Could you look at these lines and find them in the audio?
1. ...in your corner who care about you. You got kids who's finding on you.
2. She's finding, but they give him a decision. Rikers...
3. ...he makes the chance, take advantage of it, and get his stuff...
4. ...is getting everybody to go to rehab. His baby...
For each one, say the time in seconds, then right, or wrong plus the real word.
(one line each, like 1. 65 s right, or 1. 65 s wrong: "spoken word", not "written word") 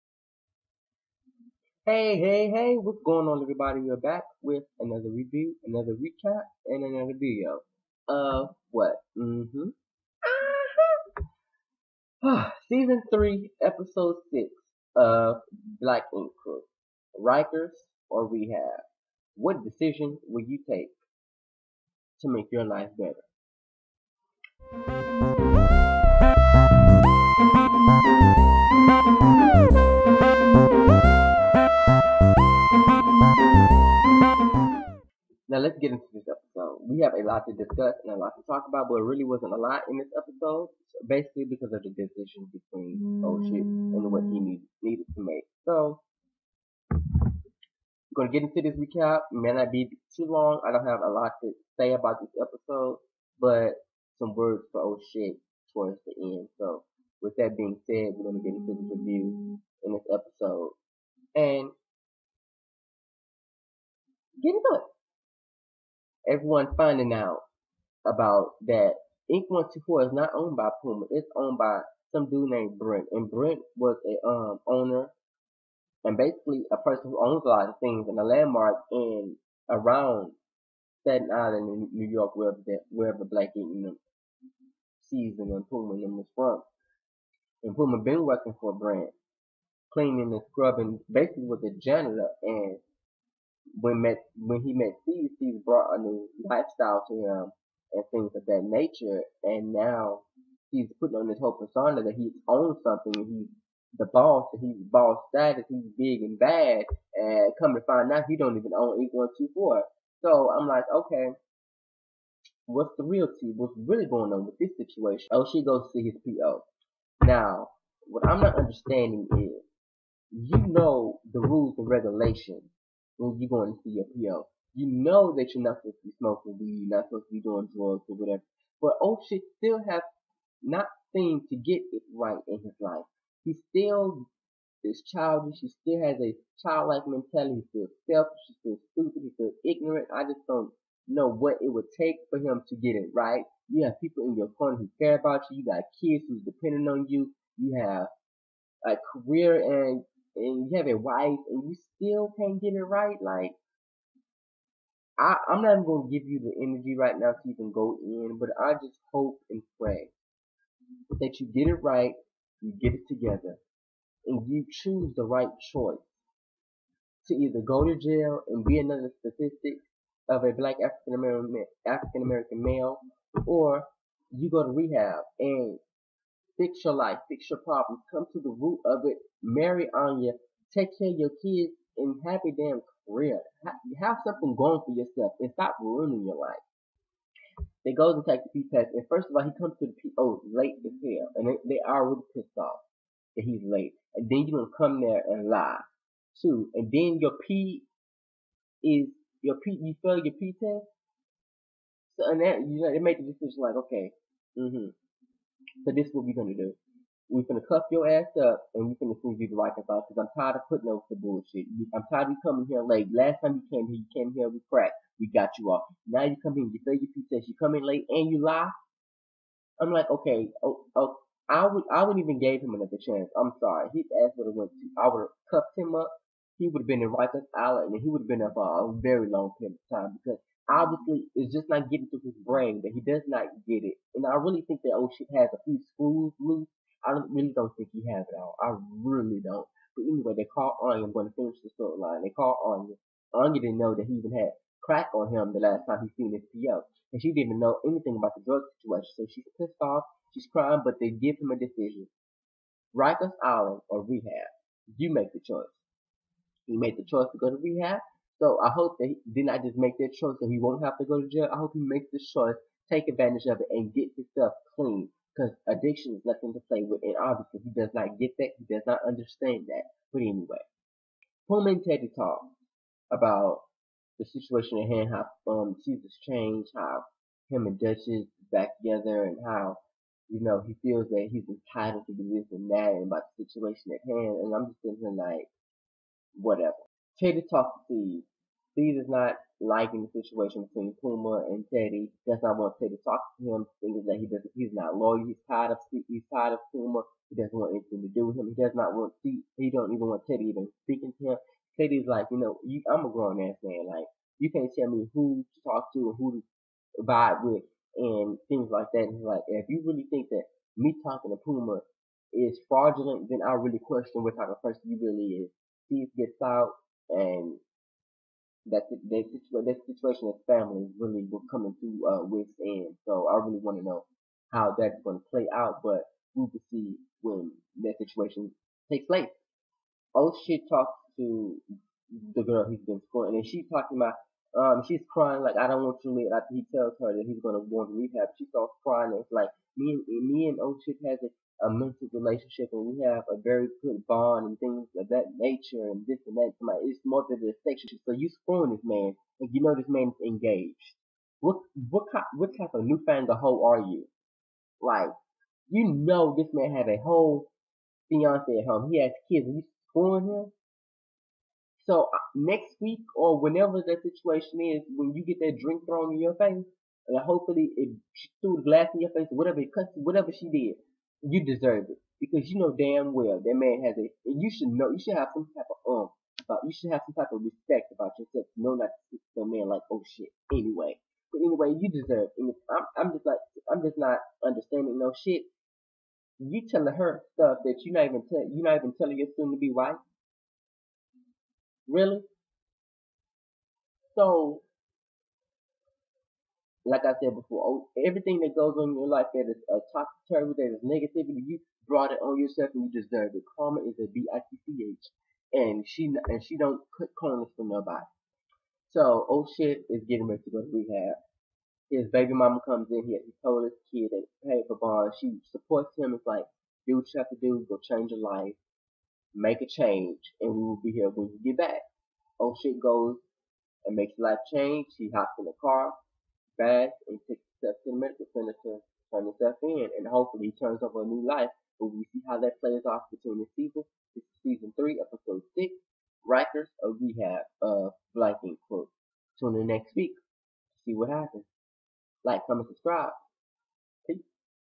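1. 144 s wrong: "depending", not "finding"
2. 250 s wrong: "crying", not "finding"
3. 261 s wrong: "choice", not "chance"
4. 409 s wrong: "ready", not "everybody".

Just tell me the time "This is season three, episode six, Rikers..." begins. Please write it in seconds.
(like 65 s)
434 s.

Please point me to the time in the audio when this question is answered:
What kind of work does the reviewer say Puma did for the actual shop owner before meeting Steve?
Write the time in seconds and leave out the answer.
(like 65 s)
91 s.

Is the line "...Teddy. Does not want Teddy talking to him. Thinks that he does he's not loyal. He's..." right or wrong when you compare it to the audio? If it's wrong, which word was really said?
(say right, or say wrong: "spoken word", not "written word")
right.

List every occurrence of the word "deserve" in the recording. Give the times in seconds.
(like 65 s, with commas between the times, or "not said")
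371 s, 381 s, 403 s.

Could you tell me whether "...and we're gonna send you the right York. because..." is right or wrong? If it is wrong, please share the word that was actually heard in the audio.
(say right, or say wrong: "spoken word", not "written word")
wrong: "Island", not "York".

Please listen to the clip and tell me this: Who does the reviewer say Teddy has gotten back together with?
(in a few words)
Dutchess.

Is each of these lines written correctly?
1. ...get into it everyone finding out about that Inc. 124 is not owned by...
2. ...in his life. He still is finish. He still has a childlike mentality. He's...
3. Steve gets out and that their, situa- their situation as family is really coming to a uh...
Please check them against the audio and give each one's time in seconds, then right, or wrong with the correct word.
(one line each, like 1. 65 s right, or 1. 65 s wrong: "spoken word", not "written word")
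1. 64 s right
2. 132 s wrong: "childish", not "finish"
3. 315 s right.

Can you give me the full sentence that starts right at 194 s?
And then you're gonna come there and lie, too.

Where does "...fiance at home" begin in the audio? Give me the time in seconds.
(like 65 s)
358 s.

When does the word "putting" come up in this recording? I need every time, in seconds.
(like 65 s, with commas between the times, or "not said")
100 s, 210 s.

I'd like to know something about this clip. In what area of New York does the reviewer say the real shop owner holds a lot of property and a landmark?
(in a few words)
Staten Island.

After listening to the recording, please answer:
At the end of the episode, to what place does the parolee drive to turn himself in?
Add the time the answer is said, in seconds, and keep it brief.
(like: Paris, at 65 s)
the medical center, at 427 s.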